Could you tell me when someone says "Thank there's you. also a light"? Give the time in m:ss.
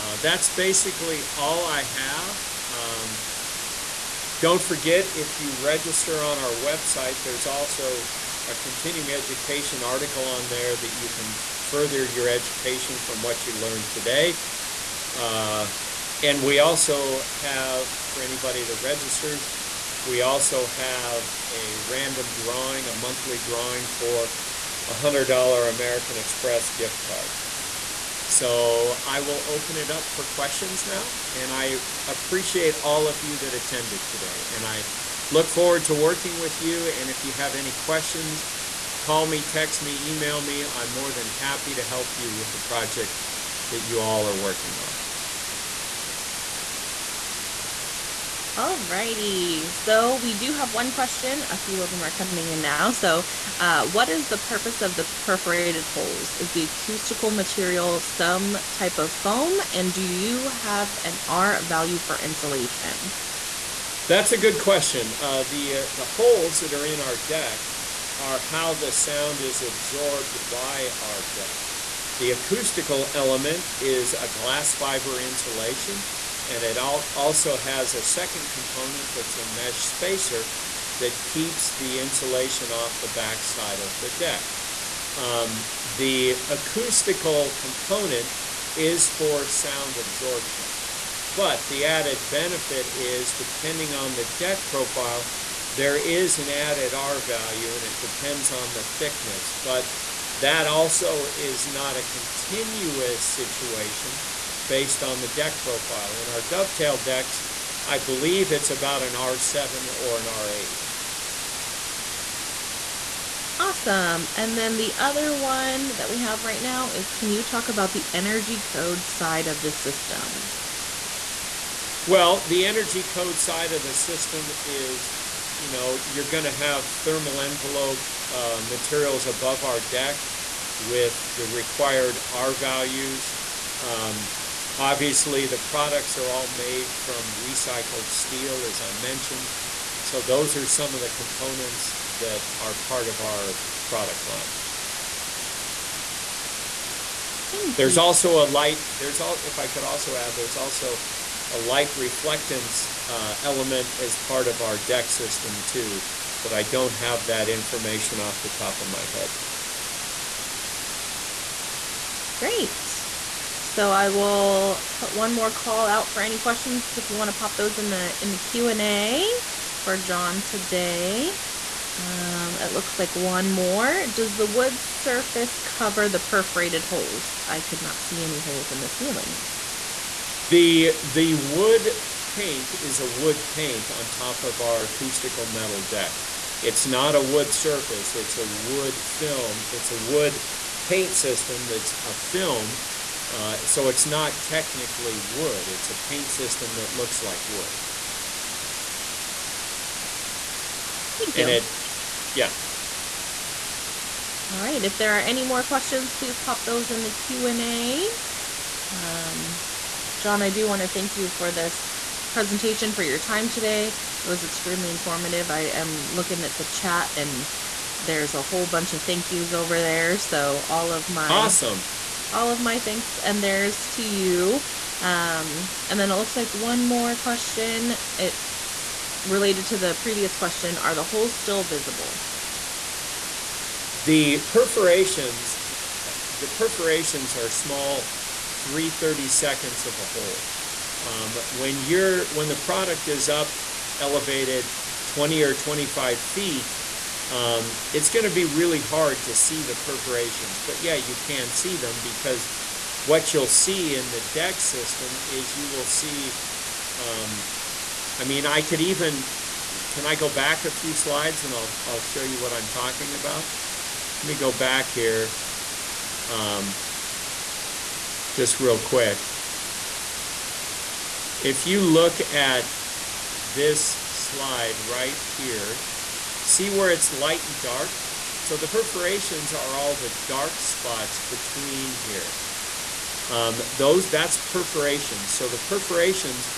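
2:27.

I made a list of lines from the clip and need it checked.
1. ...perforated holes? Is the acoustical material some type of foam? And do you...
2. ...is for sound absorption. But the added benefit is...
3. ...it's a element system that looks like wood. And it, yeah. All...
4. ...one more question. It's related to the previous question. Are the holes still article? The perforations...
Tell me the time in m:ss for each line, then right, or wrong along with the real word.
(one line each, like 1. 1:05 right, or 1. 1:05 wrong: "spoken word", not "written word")
1. 0:55 right
2. 1:28 right
3. 3:15 wrong: "paint", not "element"
4. 3:46 wrong: "visible", not "article".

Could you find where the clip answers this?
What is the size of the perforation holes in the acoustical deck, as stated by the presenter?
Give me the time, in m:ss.
3:58.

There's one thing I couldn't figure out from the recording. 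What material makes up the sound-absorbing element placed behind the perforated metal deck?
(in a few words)
glass fiber insulation.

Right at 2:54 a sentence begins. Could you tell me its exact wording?
Does the wood surface cover the perforated holes?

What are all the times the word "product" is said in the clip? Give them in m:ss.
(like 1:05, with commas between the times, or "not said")
2:15, 2:23, 4:02.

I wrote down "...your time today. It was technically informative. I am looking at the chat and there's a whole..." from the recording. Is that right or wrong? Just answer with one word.
wrong.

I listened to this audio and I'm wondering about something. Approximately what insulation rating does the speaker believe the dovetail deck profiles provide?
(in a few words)
R7 or R8.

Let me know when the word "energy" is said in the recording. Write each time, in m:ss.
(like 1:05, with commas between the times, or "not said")
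1:58, 2:02.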